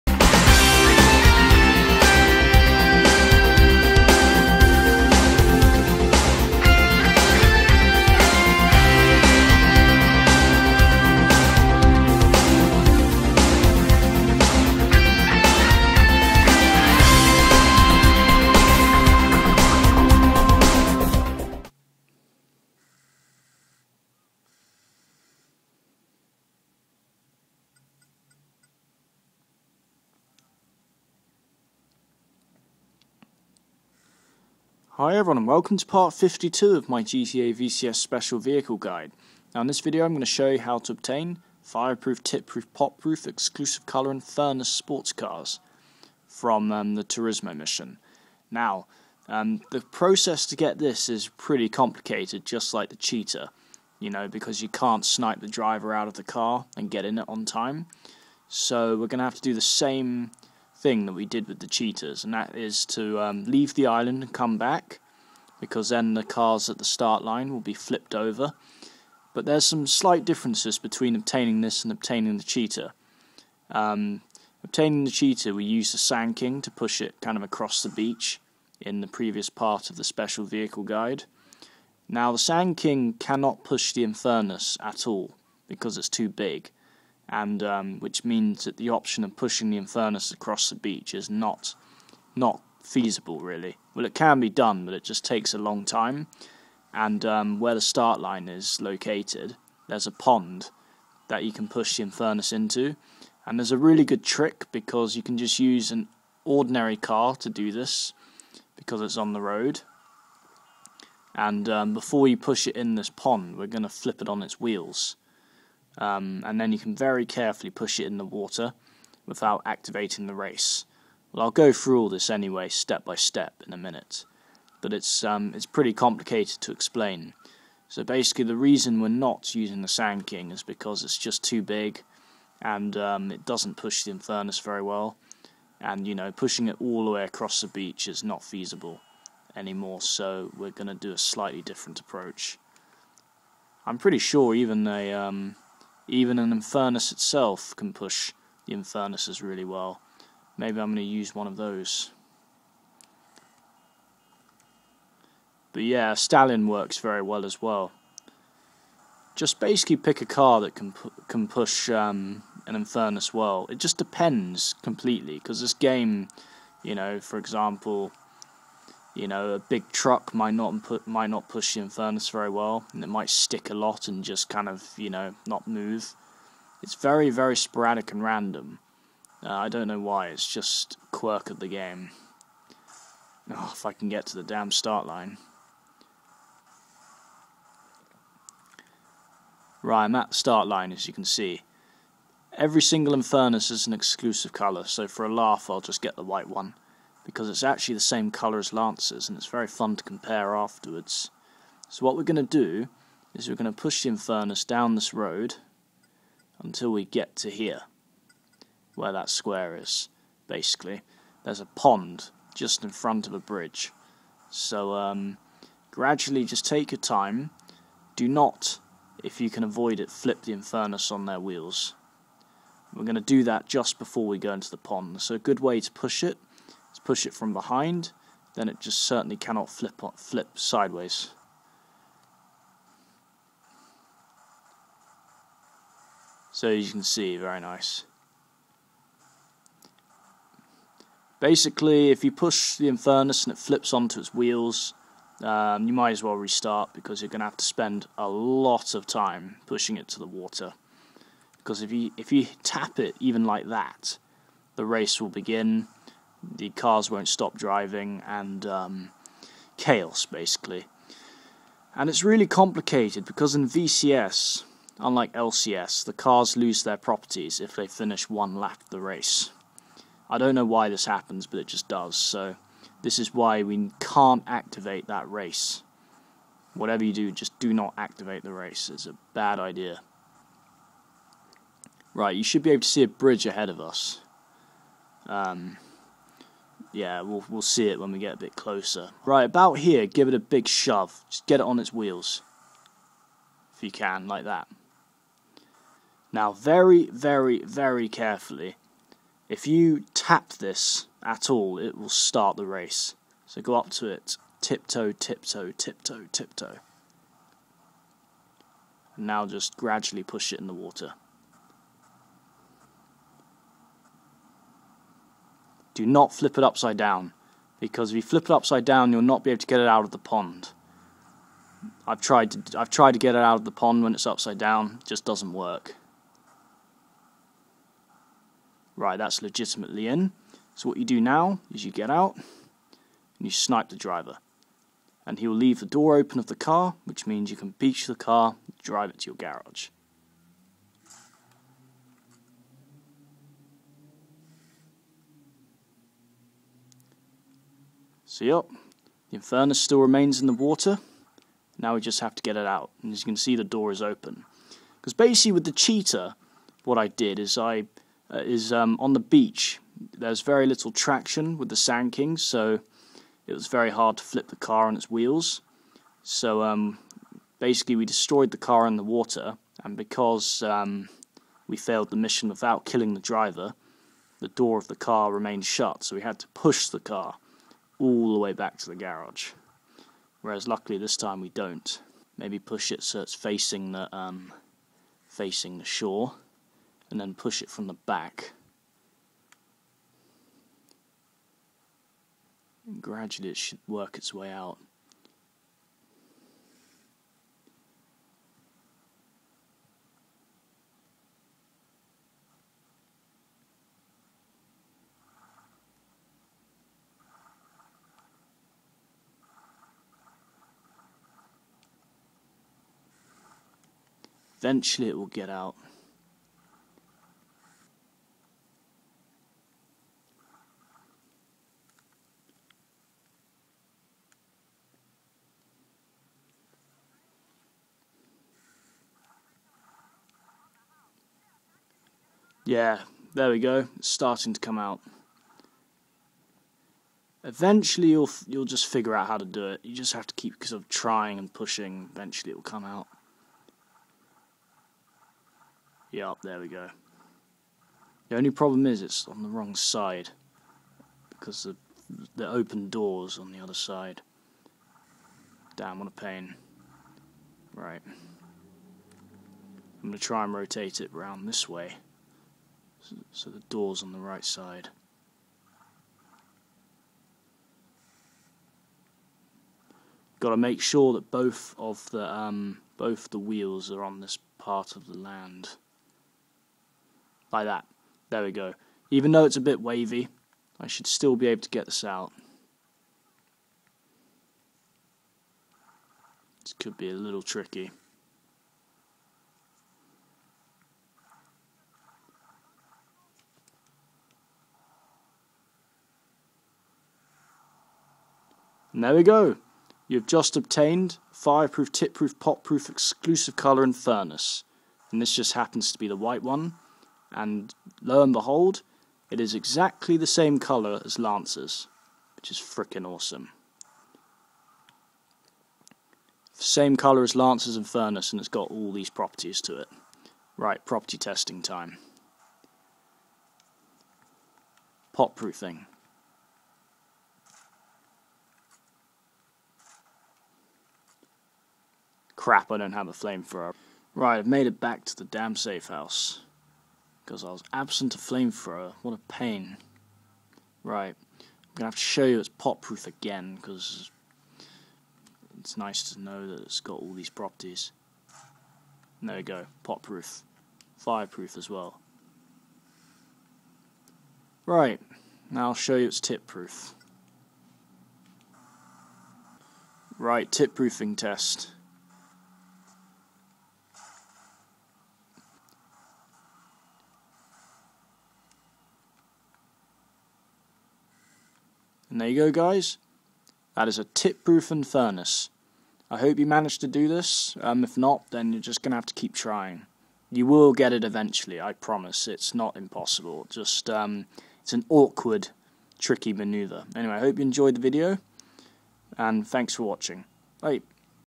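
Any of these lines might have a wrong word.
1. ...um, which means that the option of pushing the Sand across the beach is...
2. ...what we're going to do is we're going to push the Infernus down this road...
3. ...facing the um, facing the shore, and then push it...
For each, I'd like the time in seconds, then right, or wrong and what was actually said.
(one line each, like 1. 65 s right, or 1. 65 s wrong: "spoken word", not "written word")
1. 87 s wrong: "Infernus", not "Sand"
2. 202 s right
3. 383 s right.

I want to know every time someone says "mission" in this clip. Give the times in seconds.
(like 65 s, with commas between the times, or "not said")
47 s, 372 s.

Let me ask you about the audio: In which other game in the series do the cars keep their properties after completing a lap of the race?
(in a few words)
LCS.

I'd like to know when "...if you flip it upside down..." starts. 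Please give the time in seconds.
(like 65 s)
318 s.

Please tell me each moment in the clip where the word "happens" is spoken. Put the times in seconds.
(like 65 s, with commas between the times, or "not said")
271 s, 505 s.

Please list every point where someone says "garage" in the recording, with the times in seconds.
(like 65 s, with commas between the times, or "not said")
339 s, 378 s.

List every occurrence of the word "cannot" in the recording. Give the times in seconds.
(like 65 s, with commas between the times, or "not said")
83 s, 229 s.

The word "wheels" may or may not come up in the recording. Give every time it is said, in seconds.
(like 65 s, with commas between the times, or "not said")
114 s, 221 s, 244 s, 291 s, 365 s, 473 s.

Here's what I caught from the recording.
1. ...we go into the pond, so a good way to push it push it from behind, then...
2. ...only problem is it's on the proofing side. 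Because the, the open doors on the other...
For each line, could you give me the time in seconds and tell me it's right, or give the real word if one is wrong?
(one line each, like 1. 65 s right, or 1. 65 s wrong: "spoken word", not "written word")
1. 224 s right
2. 448 s wrong: "wrong", not "proofing".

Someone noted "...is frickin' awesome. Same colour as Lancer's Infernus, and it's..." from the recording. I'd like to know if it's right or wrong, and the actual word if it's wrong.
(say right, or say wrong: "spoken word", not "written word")
right.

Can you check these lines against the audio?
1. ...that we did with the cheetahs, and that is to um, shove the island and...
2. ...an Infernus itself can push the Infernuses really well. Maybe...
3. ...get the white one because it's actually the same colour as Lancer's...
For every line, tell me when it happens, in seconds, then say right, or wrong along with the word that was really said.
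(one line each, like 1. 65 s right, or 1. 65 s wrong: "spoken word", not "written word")
1. 61 s wrong: "leave", not "shove"
2. 146 s right
3. 196 s right.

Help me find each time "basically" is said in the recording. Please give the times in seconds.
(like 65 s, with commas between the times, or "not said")
128 s, 159 s, 210 s, 241 s, 260 s, 355 s, 367 s.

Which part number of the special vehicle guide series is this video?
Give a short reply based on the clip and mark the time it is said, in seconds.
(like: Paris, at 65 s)
52, at 35 s.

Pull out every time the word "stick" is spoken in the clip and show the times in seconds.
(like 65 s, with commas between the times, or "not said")
173 s.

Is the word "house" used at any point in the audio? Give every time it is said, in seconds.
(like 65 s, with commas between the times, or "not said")
535 s.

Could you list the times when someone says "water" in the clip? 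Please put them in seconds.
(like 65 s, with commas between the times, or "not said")
118 s, 250 s, 310 s, 350 s, 369 s.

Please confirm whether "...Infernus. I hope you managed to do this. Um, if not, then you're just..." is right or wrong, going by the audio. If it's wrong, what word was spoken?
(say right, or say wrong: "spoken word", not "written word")
right.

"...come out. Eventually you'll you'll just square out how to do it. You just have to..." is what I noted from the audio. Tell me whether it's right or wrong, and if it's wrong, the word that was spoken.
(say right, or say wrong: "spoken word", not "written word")
wrong: "figure", not "square".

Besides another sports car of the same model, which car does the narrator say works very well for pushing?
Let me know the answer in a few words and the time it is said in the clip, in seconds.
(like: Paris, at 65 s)
Stallion, at 156 s.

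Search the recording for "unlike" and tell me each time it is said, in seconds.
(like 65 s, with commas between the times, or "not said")
264 s.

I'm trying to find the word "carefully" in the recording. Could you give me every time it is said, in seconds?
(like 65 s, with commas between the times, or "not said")
117 s, 298 s.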